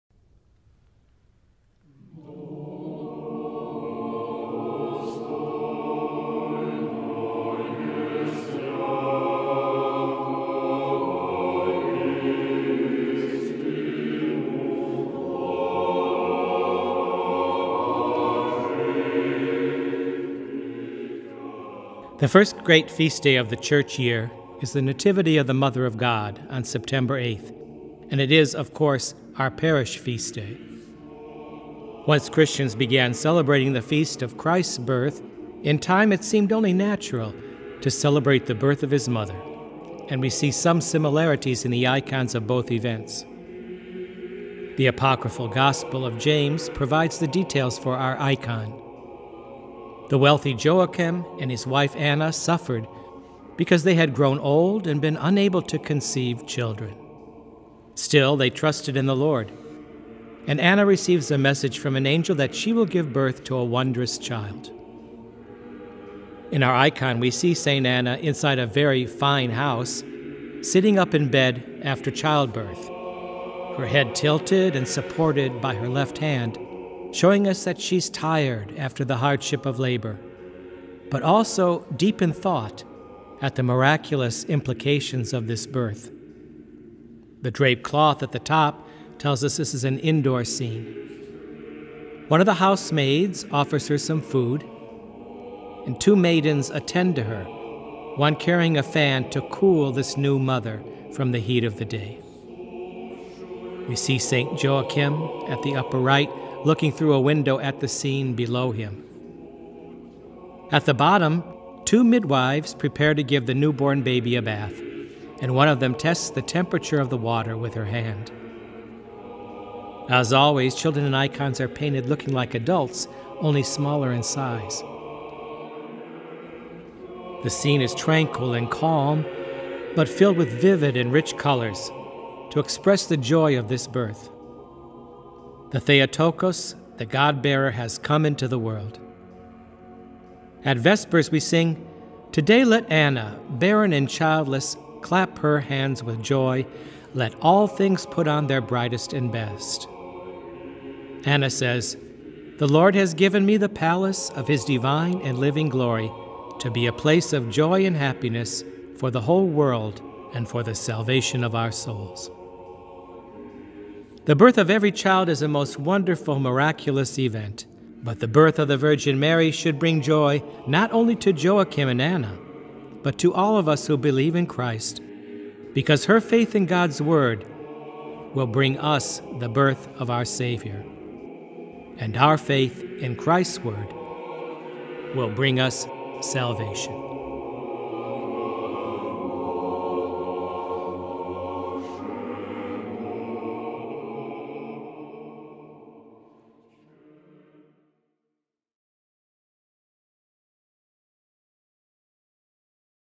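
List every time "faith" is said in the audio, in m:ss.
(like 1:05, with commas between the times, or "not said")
2:56, 3:02.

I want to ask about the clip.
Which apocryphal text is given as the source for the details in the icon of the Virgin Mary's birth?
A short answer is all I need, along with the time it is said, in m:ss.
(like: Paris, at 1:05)
Gospel of James, at 0:45.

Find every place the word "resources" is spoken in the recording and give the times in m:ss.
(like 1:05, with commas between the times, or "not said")
not said.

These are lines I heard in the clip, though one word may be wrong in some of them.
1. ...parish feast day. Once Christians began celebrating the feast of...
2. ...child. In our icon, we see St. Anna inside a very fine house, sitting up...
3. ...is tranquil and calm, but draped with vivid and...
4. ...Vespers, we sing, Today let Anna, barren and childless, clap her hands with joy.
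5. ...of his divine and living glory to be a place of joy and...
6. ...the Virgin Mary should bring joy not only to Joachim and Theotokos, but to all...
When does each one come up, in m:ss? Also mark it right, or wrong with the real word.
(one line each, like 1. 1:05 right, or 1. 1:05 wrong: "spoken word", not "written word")
1. 0:29 right
2. 1:04 right
3. 2:07 wrong: "filled", not "draped"
4. 2:20 right
5. 2:34 right
6. 2:48 wrong: "Anna", not "Theotokos".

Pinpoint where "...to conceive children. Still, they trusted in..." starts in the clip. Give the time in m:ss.
0:55.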